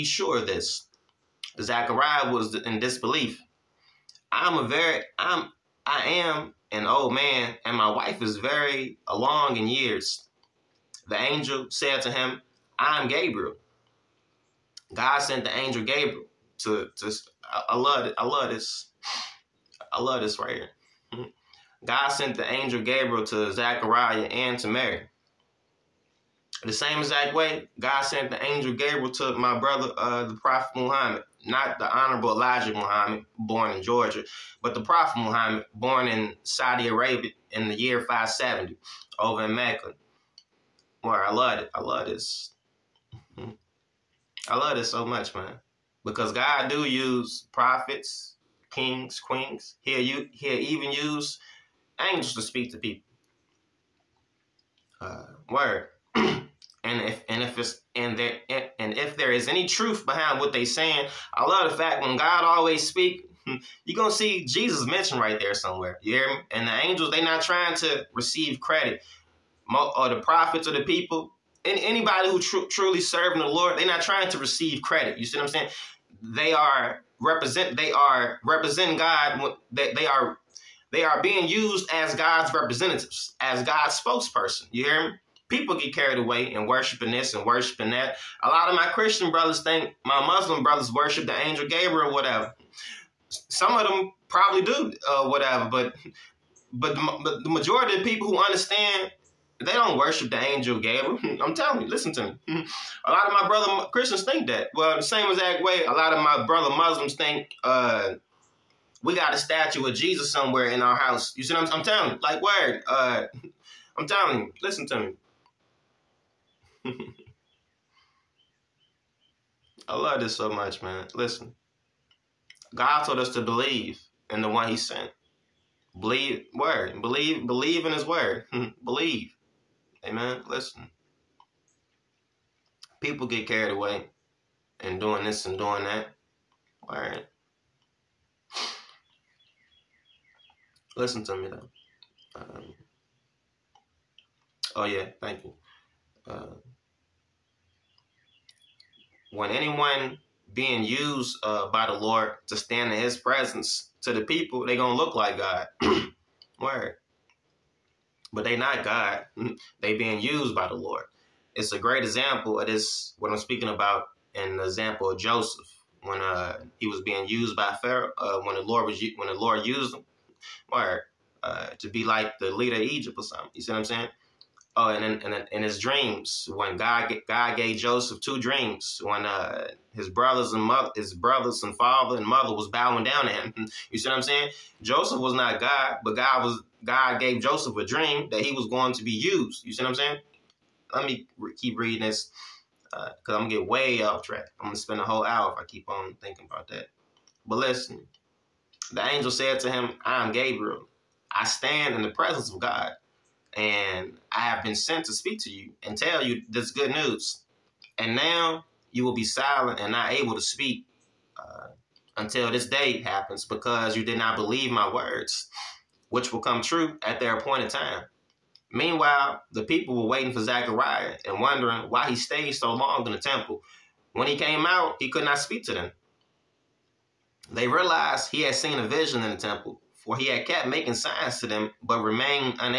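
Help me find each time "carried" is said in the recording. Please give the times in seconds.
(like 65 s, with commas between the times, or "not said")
85 s, 133 s.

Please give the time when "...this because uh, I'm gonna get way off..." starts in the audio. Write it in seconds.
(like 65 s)
192 s.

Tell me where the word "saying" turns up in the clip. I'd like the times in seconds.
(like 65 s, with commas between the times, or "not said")
60 s, 75 s, 173 s, 184 s, 189 s.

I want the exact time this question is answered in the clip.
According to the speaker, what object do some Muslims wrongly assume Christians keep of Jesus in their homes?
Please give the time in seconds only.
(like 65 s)
109 s.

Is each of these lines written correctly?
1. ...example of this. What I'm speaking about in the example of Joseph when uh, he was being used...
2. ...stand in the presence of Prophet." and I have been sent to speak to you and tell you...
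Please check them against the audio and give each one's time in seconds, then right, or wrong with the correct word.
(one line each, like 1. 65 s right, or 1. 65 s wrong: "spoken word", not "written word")
1. 162 s right
2. 201 s wrong: "God", not "Prophet".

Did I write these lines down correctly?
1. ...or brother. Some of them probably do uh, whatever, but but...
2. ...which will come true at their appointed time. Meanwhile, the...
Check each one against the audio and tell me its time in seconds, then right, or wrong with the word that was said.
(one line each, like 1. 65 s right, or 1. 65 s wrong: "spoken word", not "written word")
1. 92 s wrong: "whatever", not "brother"
2. 216 s right.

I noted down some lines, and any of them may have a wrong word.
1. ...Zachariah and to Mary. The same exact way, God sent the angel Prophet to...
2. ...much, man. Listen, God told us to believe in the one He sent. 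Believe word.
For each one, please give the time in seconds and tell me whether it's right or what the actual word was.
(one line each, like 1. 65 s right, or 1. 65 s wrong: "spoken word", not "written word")
1. 23 s wrong: "Gabriel", not "Prophet"
2. 120 s right.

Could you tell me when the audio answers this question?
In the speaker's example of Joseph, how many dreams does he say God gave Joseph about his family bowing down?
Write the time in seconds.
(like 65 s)
178 s.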